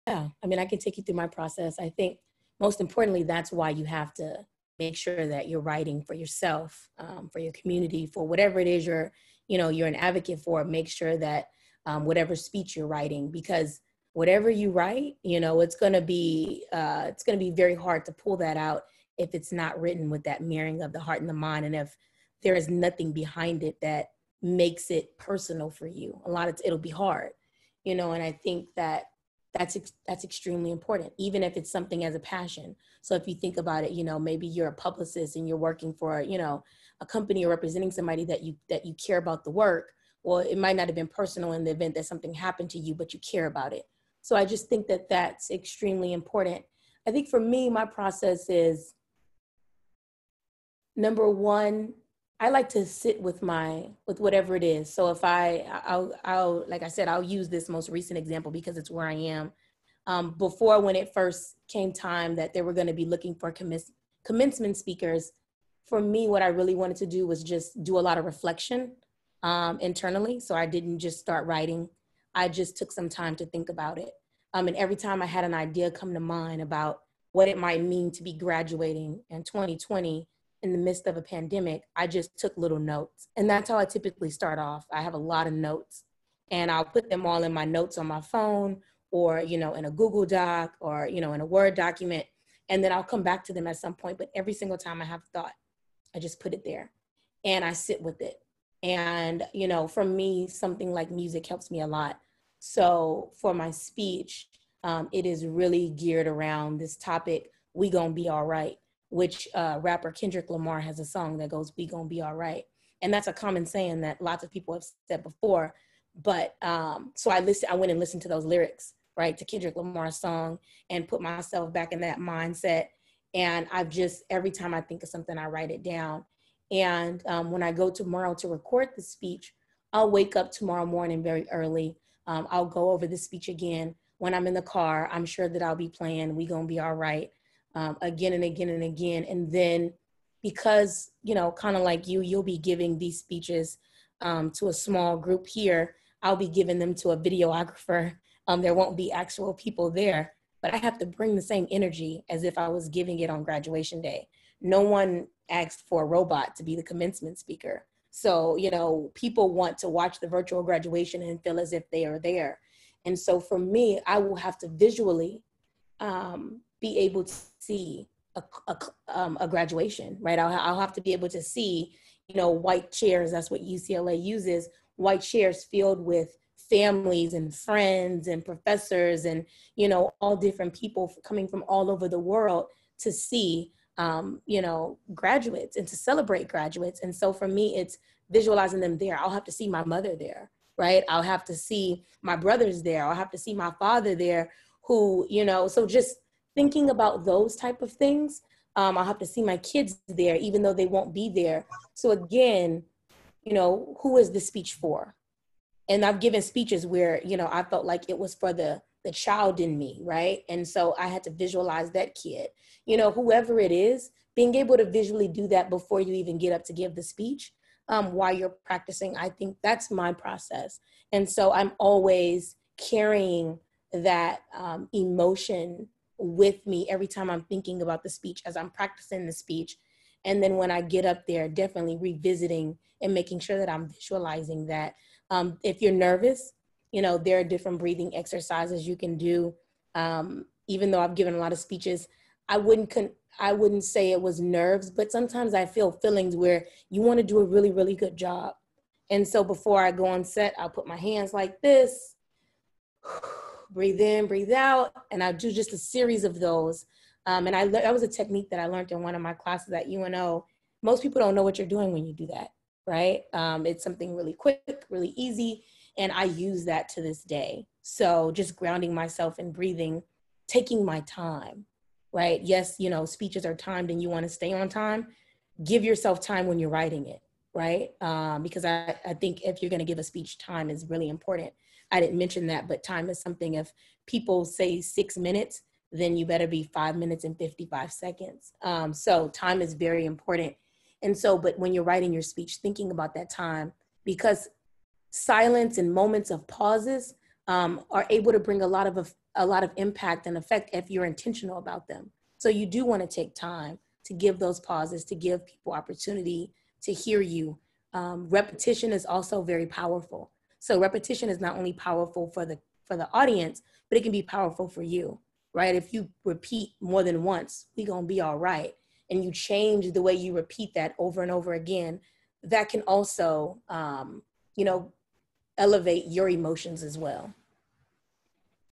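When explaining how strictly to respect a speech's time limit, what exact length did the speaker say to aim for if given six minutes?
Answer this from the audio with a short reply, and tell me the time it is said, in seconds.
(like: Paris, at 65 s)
5 minutes and 55 seconds, at 286 s.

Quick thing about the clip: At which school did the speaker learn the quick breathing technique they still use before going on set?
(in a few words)
UNO.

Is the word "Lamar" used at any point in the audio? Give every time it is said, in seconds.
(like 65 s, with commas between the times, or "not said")
110 s, 119 s.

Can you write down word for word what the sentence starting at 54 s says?
So if I I'll I'll like I said I'll use this most recent example because it's where I am.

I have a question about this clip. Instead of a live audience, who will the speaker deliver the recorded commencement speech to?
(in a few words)
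A videographer.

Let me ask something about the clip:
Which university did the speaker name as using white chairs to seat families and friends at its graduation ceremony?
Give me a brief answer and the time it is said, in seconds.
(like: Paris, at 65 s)
UCLA, at 173 s.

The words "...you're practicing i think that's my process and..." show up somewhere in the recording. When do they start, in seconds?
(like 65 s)
218 s.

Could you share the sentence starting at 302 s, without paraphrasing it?
So you do want to take time to give those pauses, to give people opportunity to hear you.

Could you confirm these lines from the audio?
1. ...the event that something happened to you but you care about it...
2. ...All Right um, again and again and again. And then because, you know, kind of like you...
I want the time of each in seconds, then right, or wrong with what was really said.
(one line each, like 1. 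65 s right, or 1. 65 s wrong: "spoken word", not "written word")
1. 41 s right
2. 136 s right.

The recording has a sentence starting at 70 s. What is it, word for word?
So I didn't just start writing.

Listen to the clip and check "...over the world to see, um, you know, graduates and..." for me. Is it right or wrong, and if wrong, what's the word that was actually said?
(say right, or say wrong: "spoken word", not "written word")
right.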